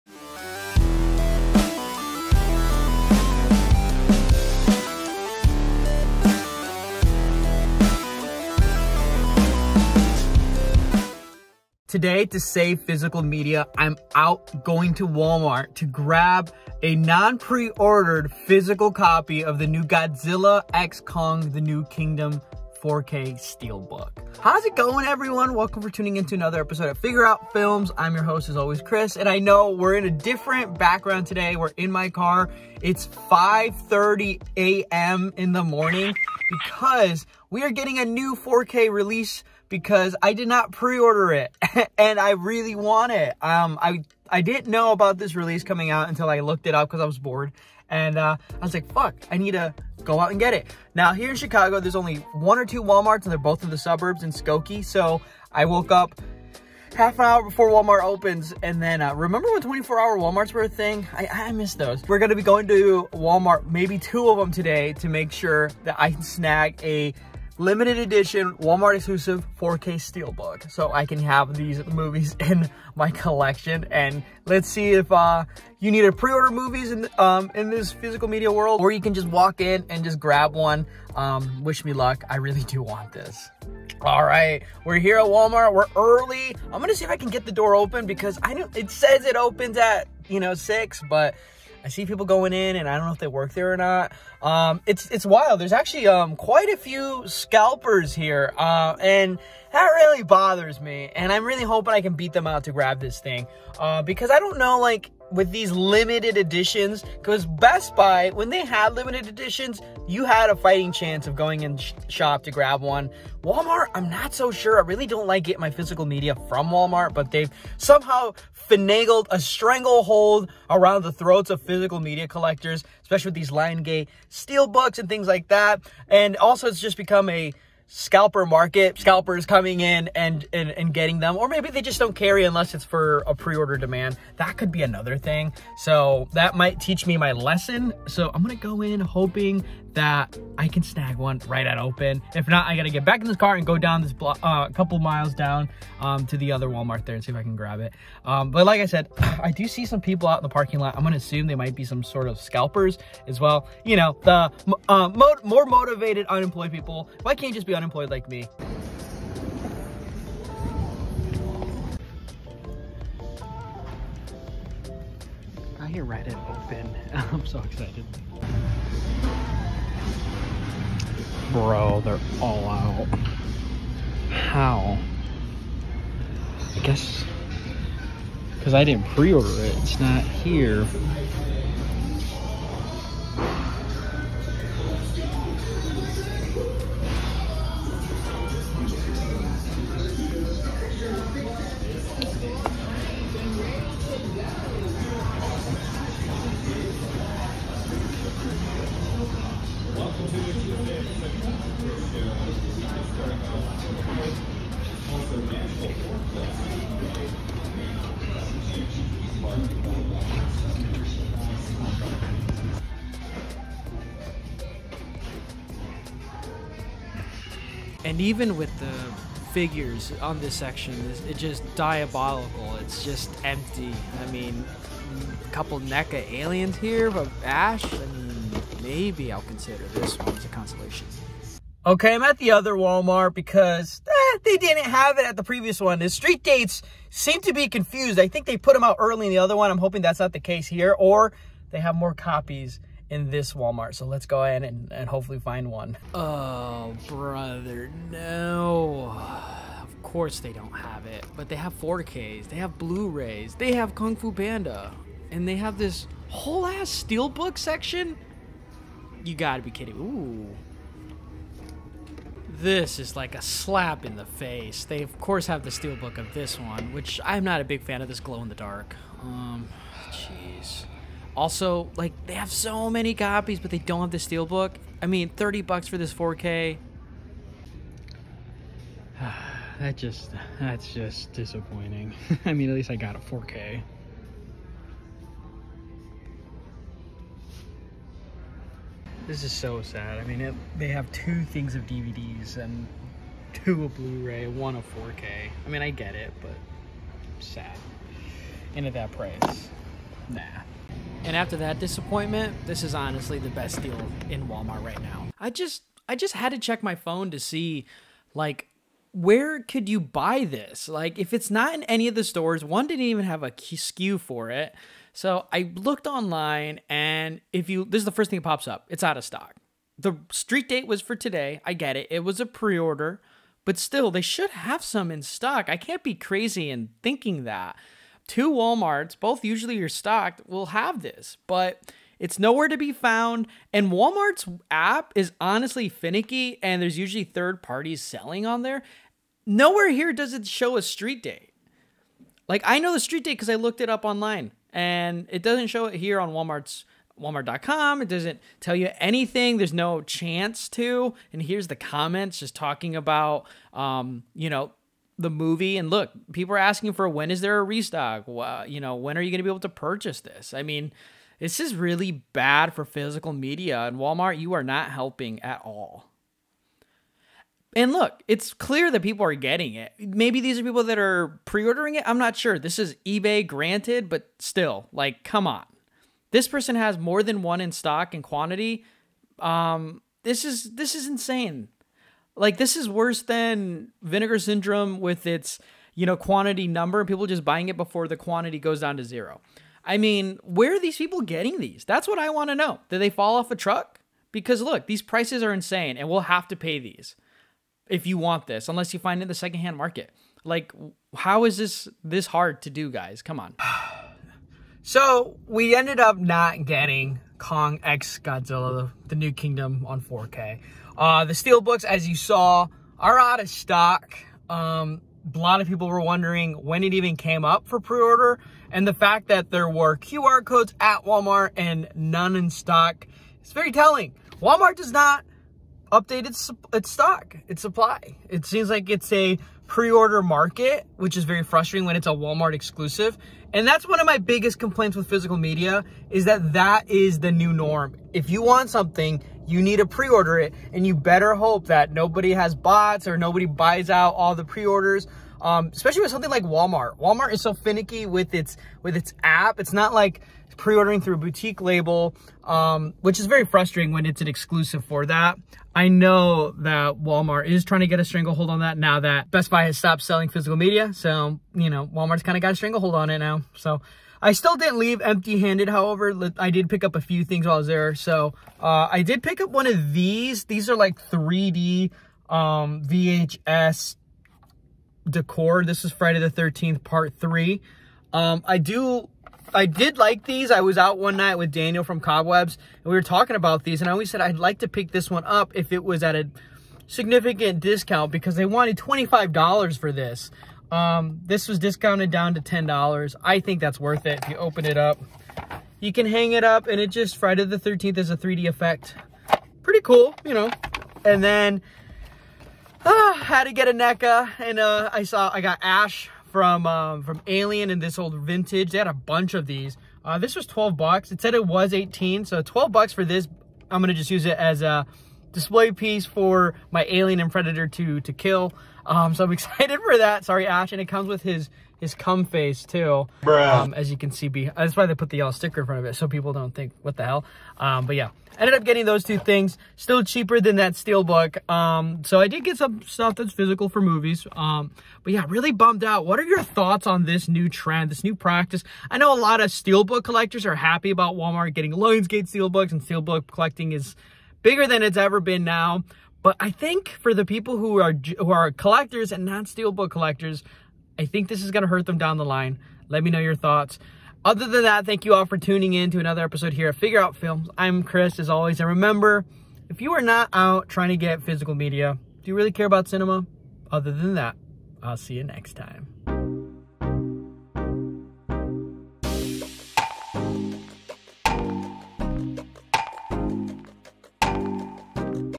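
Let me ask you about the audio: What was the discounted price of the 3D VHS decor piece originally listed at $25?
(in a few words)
$10.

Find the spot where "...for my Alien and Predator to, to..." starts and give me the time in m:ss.
8:36.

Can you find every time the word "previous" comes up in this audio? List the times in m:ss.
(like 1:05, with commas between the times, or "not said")
3:55.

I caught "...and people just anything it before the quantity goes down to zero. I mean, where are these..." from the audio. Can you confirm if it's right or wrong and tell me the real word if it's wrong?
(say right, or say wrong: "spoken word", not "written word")
wrong: "buying", not "anything".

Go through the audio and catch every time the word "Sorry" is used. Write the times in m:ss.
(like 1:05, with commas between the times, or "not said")
8:40.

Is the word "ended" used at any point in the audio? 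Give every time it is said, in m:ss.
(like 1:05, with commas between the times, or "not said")
6:45, 8:48.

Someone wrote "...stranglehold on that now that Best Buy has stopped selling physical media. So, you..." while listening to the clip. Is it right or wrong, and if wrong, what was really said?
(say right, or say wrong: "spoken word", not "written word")
right.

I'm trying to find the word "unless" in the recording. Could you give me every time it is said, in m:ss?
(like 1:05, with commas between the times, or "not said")
2:12, 6:38.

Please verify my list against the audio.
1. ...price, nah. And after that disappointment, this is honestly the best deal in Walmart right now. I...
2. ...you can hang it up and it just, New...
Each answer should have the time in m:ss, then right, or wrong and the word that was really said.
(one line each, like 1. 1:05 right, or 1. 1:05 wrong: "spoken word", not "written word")
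1. 4:59 right
2. 8:15 wrong: "Friday", not "New".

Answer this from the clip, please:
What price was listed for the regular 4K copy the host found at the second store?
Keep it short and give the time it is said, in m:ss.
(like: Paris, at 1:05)
$30, at 4:35.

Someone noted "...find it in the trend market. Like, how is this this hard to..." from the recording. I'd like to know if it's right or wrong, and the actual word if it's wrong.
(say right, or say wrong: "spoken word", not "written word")
wrong: "secondhand", not "trend".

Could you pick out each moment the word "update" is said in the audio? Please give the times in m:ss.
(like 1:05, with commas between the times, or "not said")
7:05.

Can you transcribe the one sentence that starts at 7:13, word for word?
And that's one of my biggest complaints with physical media is that that is the new norm.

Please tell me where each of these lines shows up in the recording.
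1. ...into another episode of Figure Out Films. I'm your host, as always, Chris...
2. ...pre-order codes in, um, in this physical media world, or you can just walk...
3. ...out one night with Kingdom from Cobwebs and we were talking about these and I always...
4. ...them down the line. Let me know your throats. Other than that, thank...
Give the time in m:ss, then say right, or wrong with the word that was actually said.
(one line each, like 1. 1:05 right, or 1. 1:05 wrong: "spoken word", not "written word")
1. 0:26 right
2. 1:16 wrong: "movies", not "codes"
3. 8:00 wrong: "Daniel", not "Kingdom"
4. 9:11 wrong: "thoughts", not "throats".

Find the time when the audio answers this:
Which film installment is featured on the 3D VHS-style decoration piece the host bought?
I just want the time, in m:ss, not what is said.
7:55.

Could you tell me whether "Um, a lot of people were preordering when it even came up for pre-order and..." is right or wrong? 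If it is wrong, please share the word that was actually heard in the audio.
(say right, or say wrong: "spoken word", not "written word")
wrong: "wondering", not "preordering".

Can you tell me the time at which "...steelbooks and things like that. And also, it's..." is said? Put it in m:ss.
2:04.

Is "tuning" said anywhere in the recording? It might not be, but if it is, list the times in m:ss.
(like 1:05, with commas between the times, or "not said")
0:25, 9:15.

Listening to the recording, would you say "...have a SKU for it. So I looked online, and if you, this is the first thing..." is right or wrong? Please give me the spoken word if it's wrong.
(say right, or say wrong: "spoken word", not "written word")
right.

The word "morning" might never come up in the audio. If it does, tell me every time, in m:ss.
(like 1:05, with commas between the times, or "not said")
0:35.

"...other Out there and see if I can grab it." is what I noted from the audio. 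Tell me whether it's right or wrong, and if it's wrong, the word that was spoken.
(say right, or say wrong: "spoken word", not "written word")
wrong: "Walmart", not "Out".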